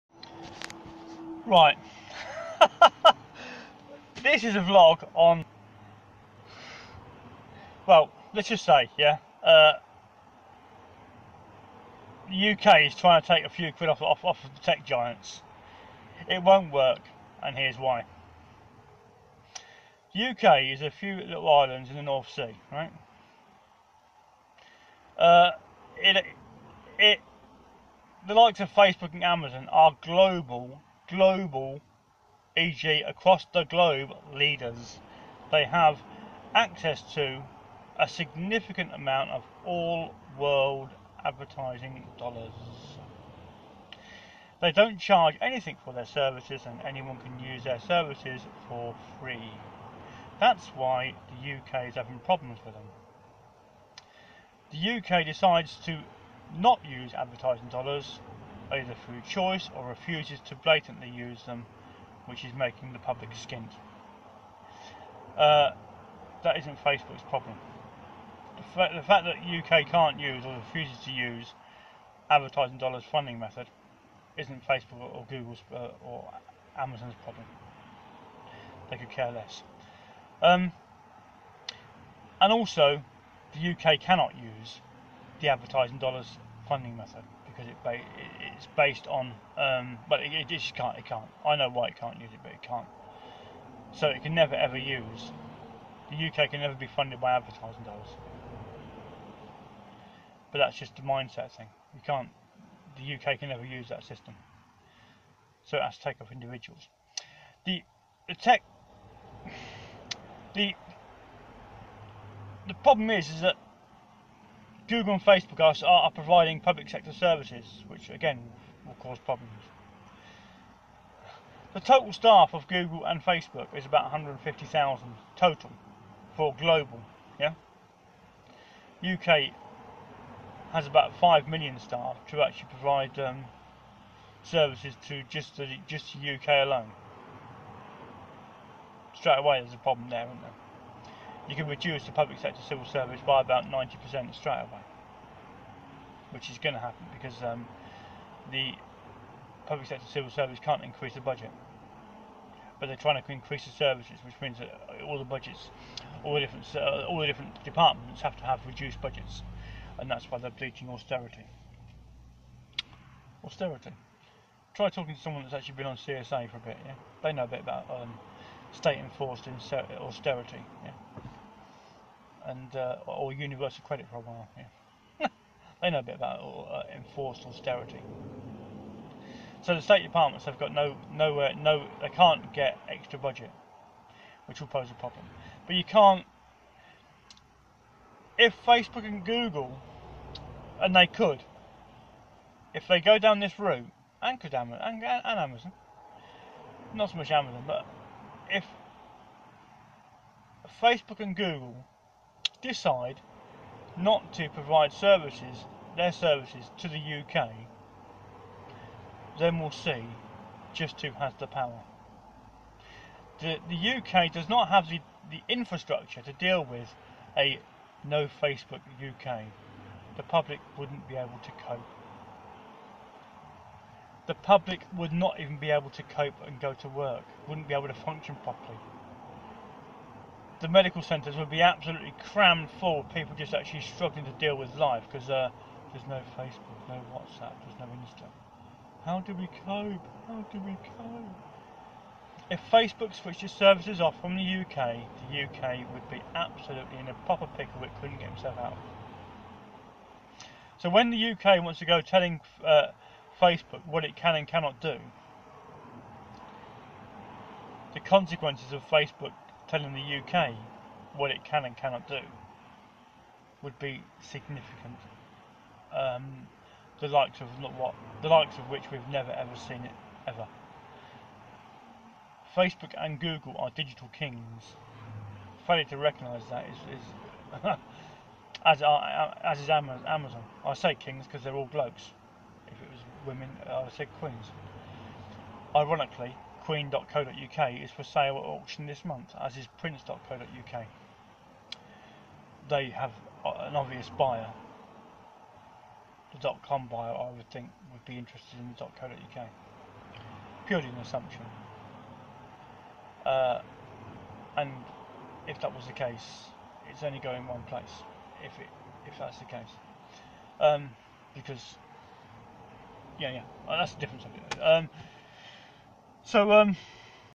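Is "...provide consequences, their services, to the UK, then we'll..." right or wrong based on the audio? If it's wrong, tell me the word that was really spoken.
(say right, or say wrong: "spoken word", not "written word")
wrong: "services", not "consequences".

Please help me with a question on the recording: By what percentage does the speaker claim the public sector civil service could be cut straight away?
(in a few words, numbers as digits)
90%.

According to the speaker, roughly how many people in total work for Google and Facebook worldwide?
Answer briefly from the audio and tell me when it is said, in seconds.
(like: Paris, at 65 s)
150,000, at 124 s.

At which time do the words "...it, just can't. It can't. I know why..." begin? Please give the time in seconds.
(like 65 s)
90 s.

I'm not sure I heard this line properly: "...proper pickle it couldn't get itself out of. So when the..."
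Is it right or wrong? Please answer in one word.
right.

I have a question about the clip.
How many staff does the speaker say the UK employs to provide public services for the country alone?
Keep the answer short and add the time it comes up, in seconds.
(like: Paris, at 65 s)
5 million, at 131 s.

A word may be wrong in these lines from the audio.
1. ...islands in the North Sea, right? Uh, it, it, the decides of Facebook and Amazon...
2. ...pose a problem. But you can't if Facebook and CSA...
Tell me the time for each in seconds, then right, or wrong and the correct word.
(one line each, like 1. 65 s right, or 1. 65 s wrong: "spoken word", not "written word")
1. 21 s wrong: "likes", not "decides"
2. 184 s wrong: "Google", not "CSA".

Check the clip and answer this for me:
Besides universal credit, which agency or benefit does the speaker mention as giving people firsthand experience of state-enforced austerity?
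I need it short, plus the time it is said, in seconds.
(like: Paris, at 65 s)
CSA, at 165 s.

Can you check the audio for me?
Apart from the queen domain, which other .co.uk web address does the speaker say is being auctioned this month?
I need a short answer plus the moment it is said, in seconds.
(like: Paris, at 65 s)
prince.co.uk, at 289 s.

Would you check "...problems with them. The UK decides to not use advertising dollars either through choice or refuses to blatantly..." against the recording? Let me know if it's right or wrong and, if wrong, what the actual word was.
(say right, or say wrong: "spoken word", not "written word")
right.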